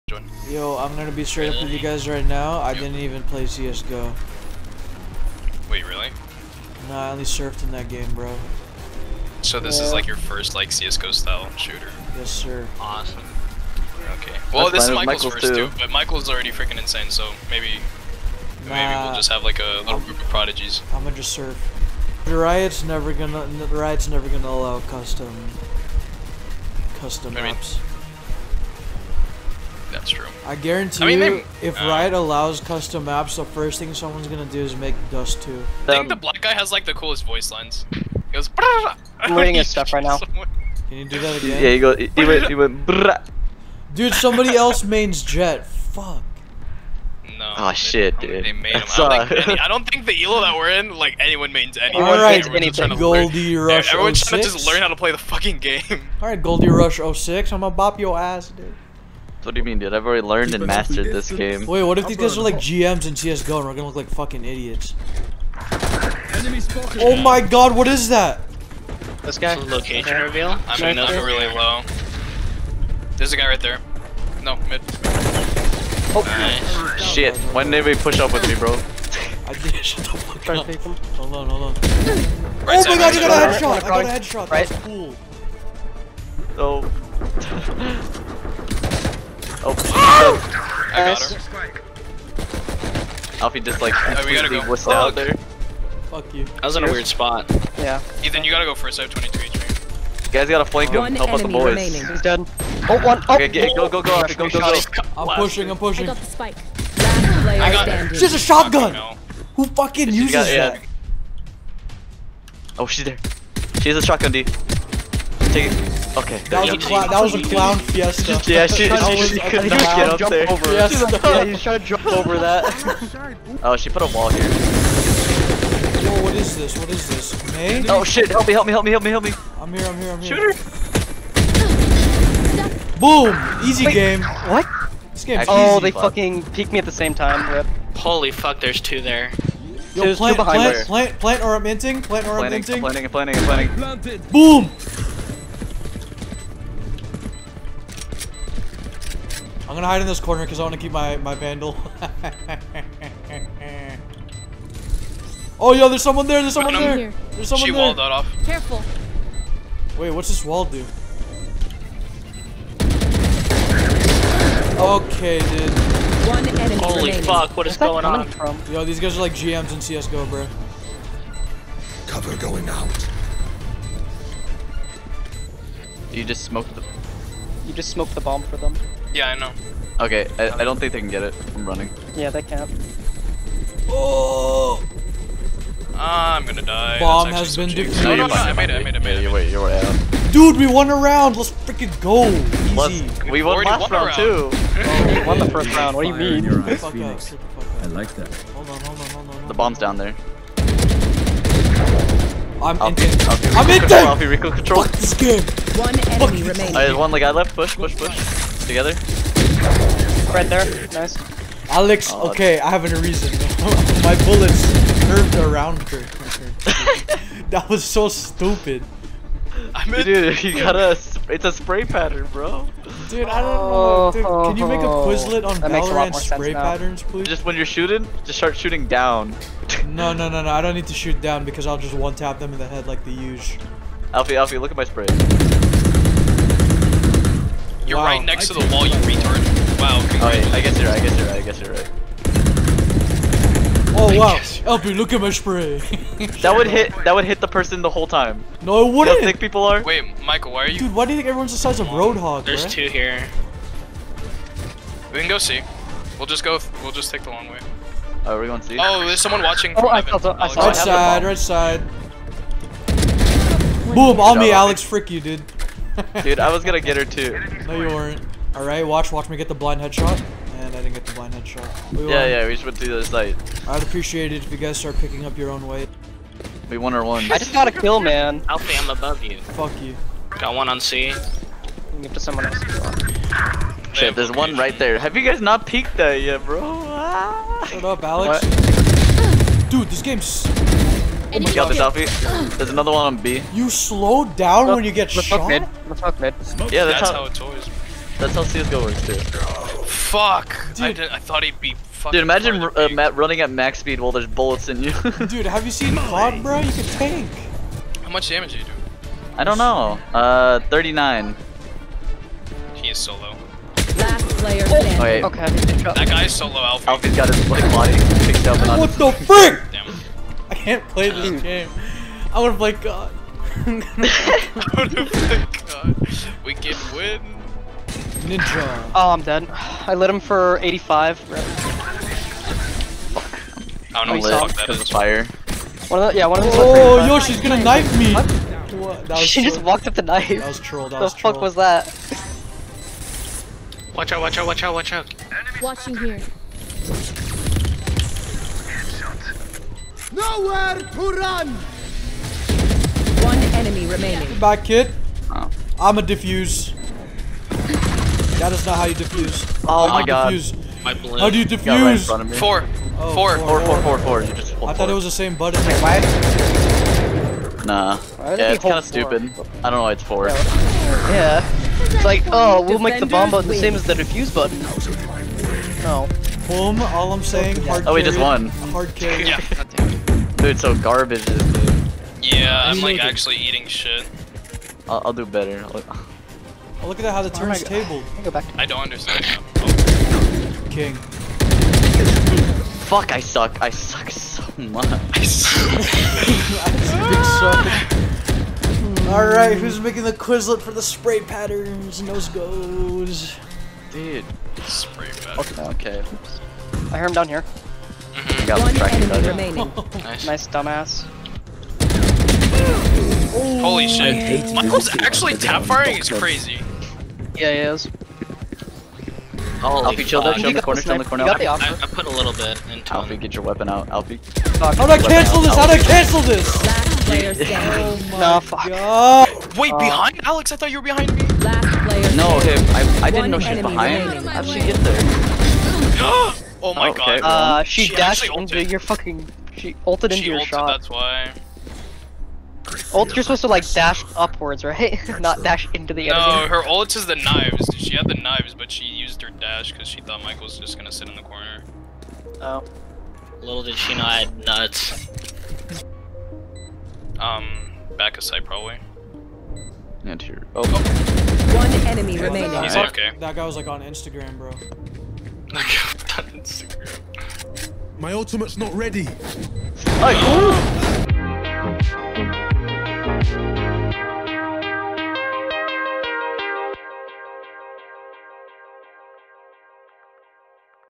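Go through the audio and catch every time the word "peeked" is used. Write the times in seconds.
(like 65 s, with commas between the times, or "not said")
136 s, 285 s.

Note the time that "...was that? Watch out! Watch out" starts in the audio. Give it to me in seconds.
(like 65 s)
341 s.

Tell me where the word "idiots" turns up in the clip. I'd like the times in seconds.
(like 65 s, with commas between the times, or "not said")
64 s.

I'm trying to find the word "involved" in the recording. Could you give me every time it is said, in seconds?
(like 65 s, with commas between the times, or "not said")
not said.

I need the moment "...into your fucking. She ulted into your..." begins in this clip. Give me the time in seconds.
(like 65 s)
438 s.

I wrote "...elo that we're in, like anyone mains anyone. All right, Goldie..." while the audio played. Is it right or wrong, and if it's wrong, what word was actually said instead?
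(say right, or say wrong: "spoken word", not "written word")
right.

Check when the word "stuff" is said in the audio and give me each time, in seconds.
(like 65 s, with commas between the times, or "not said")
39 s.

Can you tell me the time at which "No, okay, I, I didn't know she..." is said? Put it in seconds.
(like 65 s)
432 s.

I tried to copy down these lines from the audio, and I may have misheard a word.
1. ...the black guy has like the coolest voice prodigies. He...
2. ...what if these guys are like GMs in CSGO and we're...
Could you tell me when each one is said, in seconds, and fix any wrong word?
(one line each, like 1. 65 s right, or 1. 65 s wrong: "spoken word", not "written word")
1. 36 s wrong: "lines", not "prodigies"
2. 61 s right.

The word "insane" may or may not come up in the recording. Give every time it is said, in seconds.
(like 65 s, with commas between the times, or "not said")
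16 s.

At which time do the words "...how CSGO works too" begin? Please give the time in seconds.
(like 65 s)
298 s.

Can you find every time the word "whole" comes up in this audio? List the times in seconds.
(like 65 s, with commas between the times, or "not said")
247 s.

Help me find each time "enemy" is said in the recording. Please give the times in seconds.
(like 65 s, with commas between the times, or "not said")
166 s, 206 s, 353 s, 409 s, 446 s, 461 s.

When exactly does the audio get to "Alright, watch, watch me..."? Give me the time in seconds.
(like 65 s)
268 s.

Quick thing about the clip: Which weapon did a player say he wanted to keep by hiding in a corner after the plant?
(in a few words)
vandal.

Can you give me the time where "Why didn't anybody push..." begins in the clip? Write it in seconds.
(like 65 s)
77 s.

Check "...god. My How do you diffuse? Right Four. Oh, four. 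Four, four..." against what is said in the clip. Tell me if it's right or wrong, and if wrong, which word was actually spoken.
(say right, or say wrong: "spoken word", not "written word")
right.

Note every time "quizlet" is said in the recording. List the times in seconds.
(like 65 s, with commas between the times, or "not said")
224 s, 400 s.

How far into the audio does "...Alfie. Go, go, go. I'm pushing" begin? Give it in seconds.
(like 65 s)
104 s.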